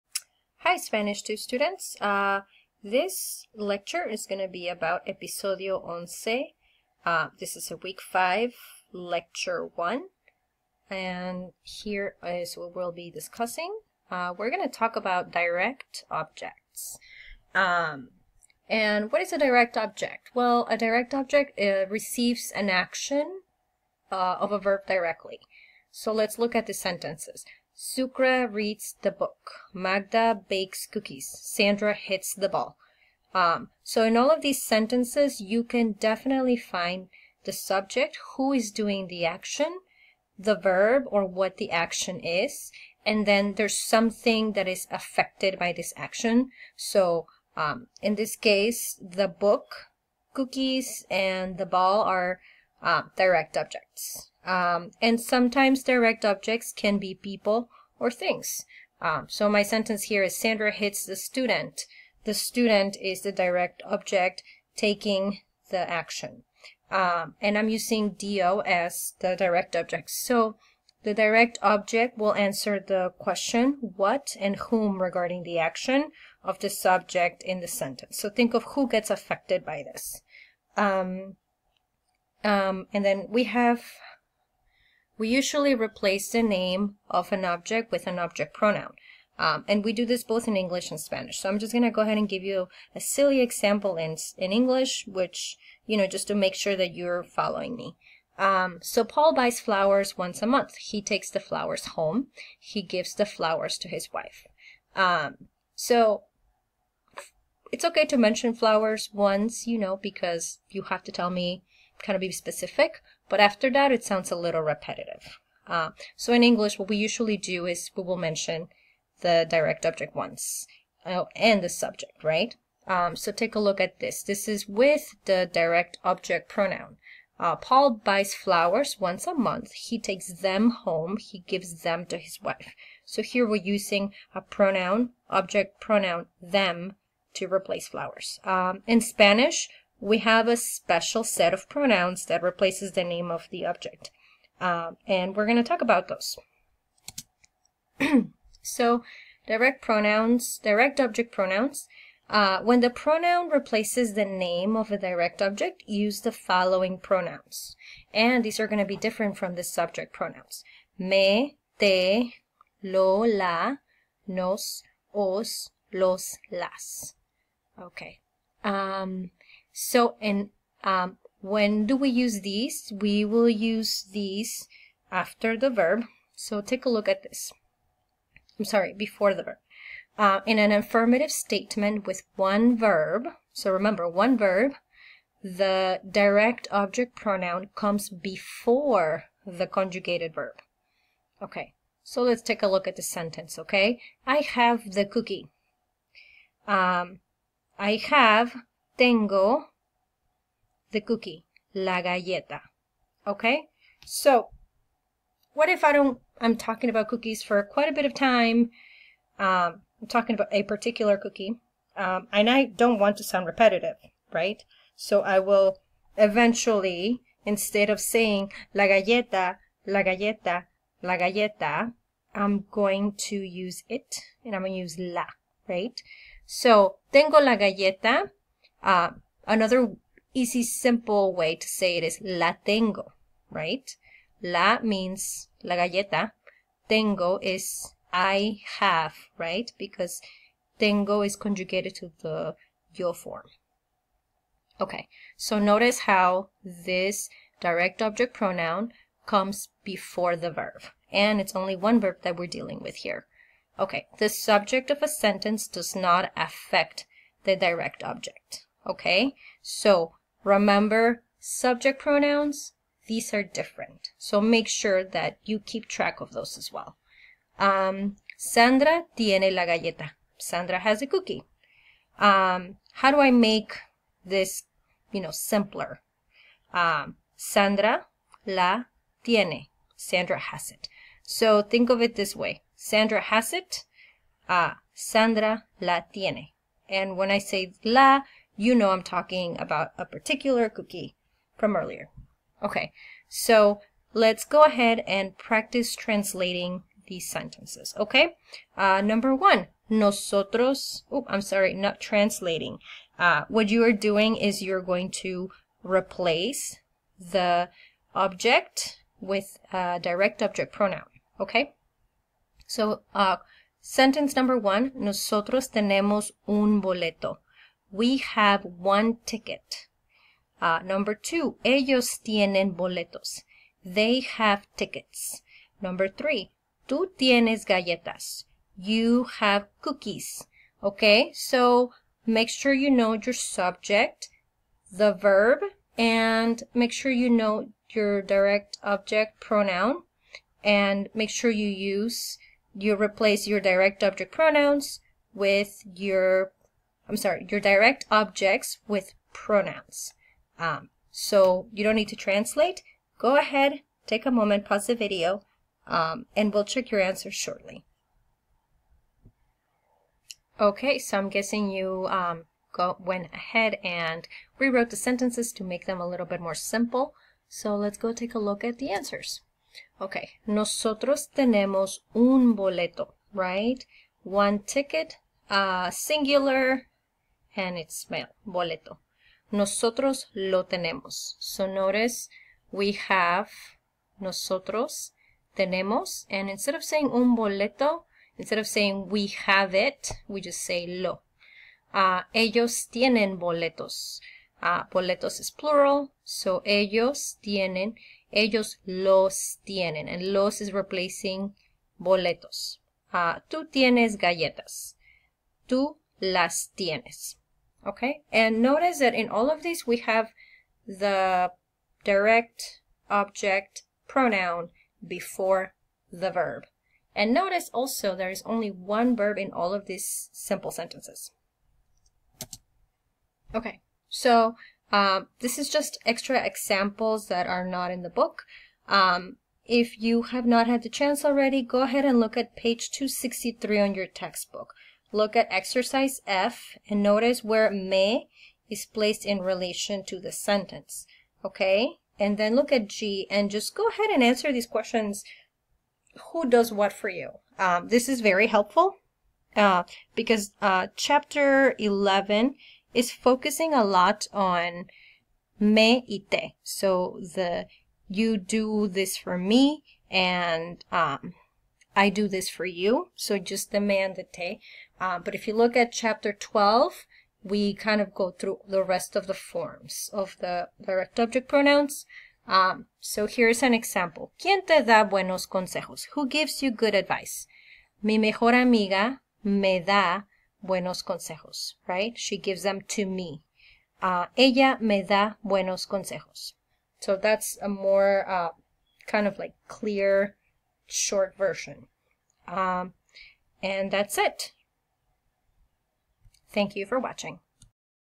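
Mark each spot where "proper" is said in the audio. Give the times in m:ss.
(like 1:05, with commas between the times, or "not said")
not said.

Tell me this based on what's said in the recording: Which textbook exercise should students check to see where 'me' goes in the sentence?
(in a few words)
F.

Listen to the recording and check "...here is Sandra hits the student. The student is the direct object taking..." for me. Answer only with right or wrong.
right.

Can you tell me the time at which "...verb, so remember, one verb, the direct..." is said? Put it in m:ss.
3:02.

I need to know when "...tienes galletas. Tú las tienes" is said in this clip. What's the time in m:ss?
6:43.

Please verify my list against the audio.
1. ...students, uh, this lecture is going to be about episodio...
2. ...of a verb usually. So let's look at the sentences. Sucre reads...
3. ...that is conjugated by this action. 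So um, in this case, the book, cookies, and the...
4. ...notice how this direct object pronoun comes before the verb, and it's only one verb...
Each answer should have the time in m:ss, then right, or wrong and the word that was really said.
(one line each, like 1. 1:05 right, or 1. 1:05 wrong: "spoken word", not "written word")
1. 0:01 right
2. 0:24 wrong: "directly", not "usually"
3. 0:44 wrong: "affected", not "conjugated"
4. 4:05 right.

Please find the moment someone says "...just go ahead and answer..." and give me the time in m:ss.
7:23.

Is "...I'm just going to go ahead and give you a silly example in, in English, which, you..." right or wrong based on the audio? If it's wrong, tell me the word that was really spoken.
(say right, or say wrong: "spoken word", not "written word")
right.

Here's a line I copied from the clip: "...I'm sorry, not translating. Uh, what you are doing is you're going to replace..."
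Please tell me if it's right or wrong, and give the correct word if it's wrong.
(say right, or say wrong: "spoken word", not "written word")
right.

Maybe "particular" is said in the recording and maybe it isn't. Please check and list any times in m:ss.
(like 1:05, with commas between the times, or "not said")
3:30, 4:50.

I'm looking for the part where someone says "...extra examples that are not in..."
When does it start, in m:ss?
7:06.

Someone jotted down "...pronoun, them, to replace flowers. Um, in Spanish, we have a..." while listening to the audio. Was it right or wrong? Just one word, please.
right.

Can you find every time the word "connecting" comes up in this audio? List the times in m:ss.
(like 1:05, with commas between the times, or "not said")
not said.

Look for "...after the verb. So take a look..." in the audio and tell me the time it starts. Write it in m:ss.
2:55.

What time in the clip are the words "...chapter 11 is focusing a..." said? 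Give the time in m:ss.
7:30.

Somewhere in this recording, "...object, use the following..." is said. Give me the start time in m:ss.
2:35.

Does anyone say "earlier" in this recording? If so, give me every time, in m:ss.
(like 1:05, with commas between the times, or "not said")
4:51.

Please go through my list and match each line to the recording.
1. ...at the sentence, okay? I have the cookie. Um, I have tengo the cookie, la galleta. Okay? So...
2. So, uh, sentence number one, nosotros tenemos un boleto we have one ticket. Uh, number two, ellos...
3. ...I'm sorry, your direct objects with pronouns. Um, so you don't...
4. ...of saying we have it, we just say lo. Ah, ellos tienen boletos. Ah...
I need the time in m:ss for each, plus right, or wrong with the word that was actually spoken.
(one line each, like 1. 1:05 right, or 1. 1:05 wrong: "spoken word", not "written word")
1. 3:12 right
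2. 5:12 right
3. 5:47 right
4. 6:28 right.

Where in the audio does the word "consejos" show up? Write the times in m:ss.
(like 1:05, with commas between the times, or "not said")
7:55, 8:01, 8:05.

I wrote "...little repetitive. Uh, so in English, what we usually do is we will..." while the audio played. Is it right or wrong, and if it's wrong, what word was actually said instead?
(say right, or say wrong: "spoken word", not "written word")
right.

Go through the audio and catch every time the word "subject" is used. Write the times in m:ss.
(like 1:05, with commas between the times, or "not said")
0:37, 1:16, 2:01, 2:39, 4:14, 4:21, 5:33.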